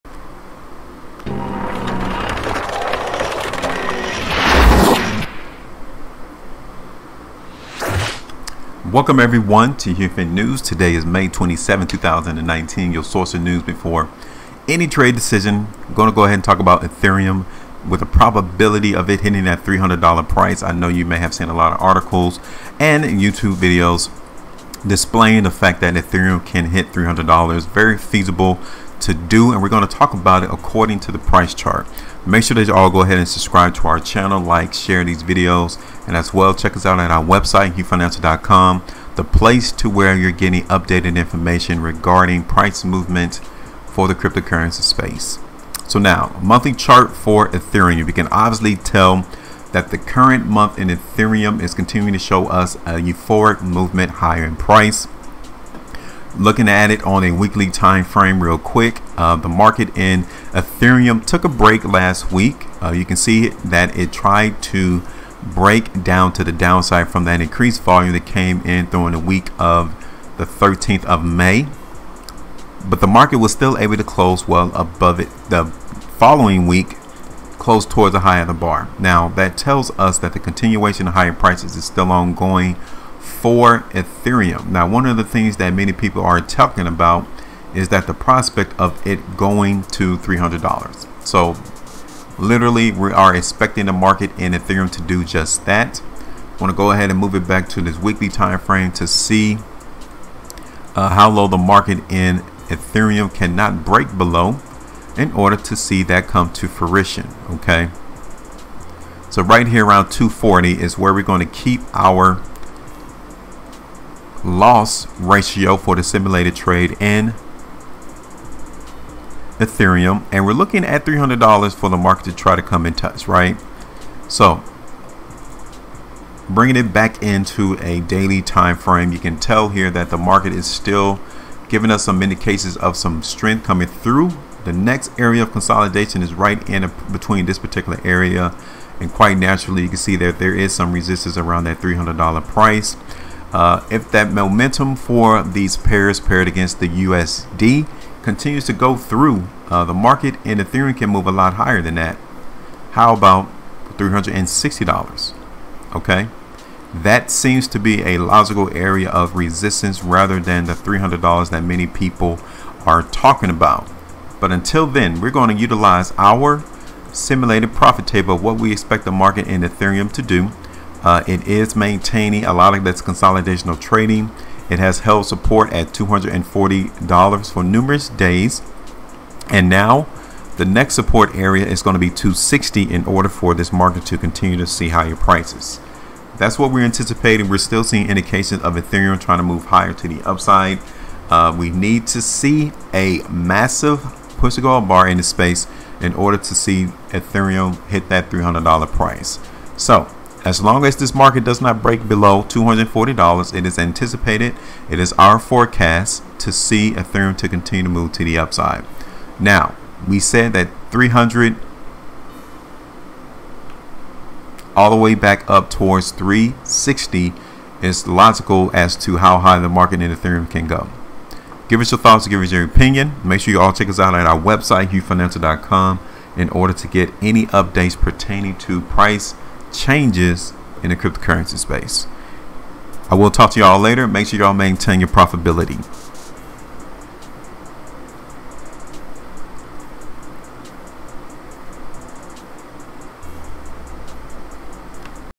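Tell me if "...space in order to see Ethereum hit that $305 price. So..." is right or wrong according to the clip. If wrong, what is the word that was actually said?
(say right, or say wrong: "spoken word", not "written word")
wrong: "300", not "305".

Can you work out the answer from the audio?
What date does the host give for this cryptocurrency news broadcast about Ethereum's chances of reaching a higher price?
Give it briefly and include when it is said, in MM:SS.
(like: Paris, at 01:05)
May 27, 2019, at 00:11.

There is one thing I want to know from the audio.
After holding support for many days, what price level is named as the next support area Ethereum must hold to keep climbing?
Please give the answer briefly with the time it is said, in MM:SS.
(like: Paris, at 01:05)
260, at 03:02.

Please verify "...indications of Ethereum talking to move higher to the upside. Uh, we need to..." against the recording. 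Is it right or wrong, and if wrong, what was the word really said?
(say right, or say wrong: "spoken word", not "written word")
wrong: "trying", not "talking".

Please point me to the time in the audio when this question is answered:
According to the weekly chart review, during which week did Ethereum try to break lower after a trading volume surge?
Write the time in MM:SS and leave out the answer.
01:10.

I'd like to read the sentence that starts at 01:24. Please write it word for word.
Now, one of the things that many people are talking about is that the prospect of it going to $300.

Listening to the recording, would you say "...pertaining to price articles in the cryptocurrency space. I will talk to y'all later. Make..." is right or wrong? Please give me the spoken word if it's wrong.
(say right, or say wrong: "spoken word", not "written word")
wrong: "changes", not "articles".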